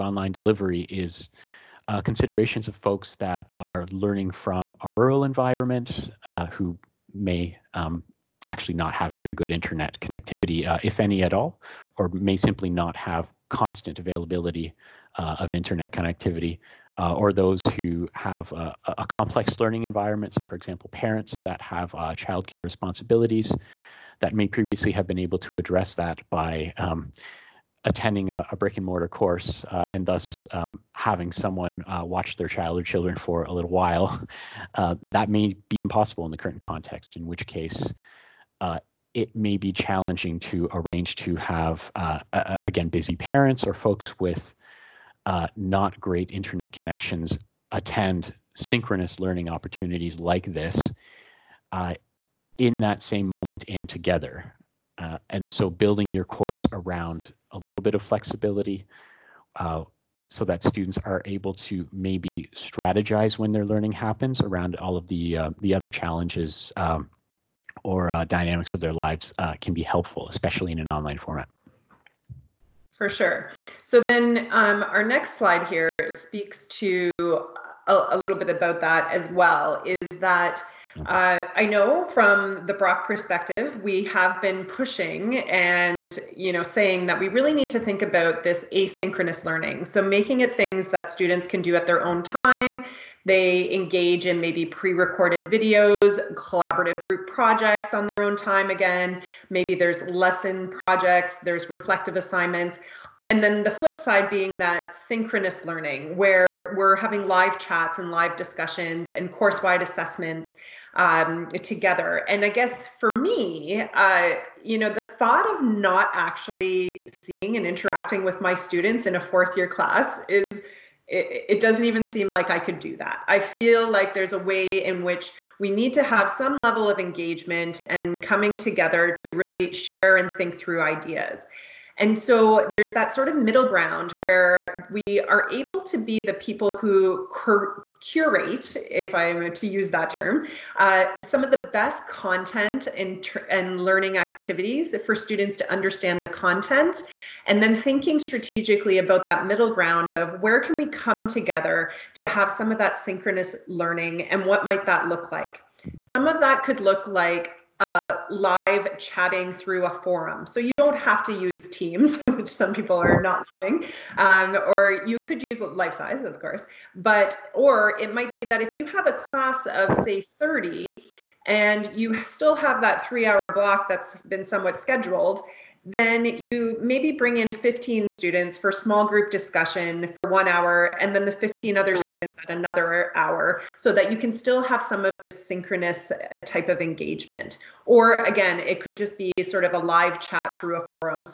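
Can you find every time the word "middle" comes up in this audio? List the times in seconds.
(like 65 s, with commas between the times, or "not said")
133 s, 149 s.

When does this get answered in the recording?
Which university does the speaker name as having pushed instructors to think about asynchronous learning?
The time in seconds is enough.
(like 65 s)
82 s.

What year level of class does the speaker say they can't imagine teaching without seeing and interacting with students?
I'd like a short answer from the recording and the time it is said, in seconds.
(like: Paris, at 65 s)
Fourth year, at 119 s.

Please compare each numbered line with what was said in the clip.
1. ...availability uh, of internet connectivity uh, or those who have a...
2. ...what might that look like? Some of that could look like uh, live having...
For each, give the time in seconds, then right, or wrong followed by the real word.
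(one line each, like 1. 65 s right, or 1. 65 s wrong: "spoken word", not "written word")
1. 13 s right
2. 154 s wrong: "chatting", not "having".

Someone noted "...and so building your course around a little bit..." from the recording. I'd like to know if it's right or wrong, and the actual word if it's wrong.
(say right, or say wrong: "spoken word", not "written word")
right.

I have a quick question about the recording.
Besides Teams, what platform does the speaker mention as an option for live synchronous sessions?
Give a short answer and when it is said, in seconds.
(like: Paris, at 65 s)
Life Size, at 165 s.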